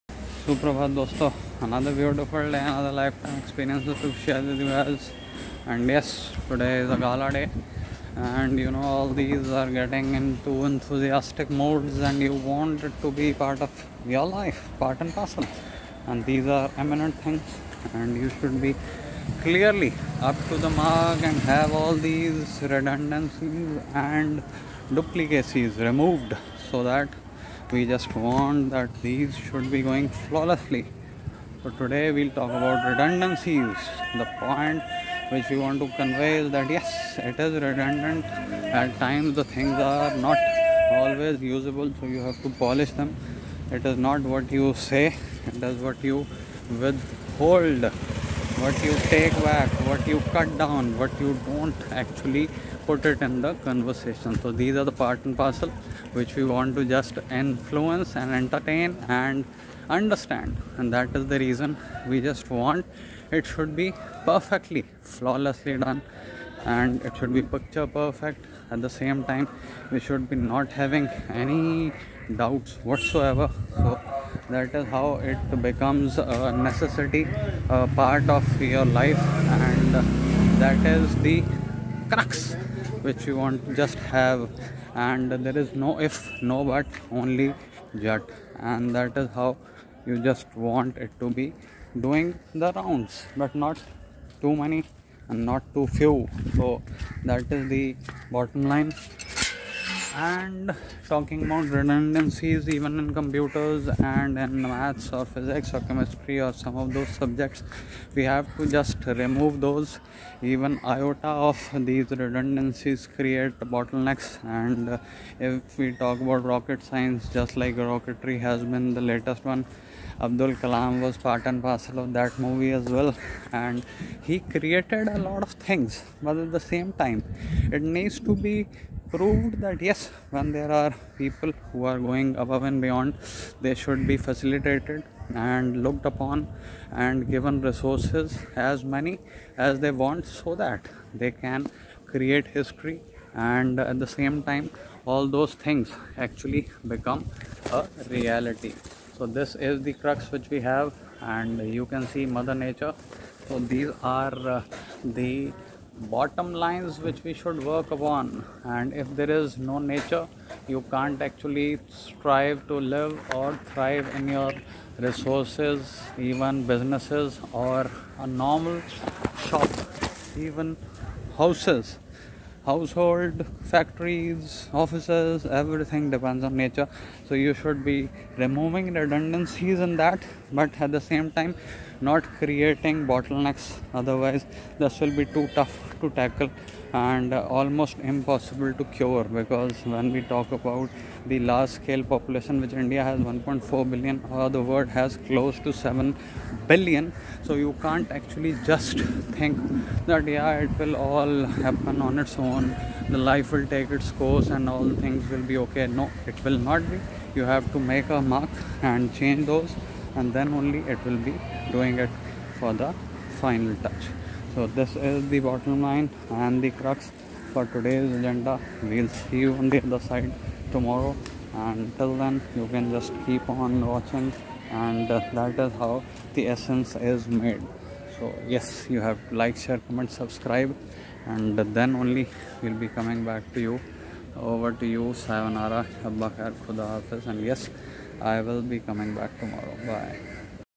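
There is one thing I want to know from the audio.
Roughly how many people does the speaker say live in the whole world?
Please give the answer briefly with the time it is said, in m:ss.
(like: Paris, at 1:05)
7 billion, at 3:15.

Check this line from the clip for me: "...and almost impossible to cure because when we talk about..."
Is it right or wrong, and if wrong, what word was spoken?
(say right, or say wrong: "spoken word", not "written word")
right.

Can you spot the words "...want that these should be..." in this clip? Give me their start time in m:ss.
0:28.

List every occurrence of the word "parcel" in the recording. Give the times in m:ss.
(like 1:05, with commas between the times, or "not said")
0:15, 0:55, 2:01.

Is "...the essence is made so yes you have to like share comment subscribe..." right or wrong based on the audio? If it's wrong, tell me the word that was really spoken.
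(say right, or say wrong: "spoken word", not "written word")
right.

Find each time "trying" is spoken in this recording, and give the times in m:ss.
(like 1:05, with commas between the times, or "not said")
not said.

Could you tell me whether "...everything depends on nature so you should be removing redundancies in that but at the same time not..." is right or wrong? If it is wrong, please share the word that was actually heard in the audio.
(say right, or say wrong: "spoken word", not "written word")
right.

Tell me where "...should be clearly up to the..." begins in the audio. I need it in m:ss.
0:18.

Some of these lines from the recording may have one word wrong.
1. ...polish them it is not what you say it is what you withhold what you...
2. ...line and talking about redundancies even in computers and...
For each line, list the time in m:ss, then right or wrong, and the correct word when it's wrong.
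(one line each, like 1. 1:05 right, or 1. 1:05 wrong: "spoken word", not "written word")
1. 0:42 right
2. 1:38 right.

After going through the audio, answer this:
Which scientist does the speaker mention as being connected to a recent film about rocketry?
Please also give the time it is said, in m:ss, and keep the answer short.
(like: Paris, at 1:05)
Abdul Kalam, at 2:00.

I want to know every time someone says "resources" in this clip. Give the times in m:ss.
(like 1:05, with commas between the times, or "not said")
2:17, 2:44.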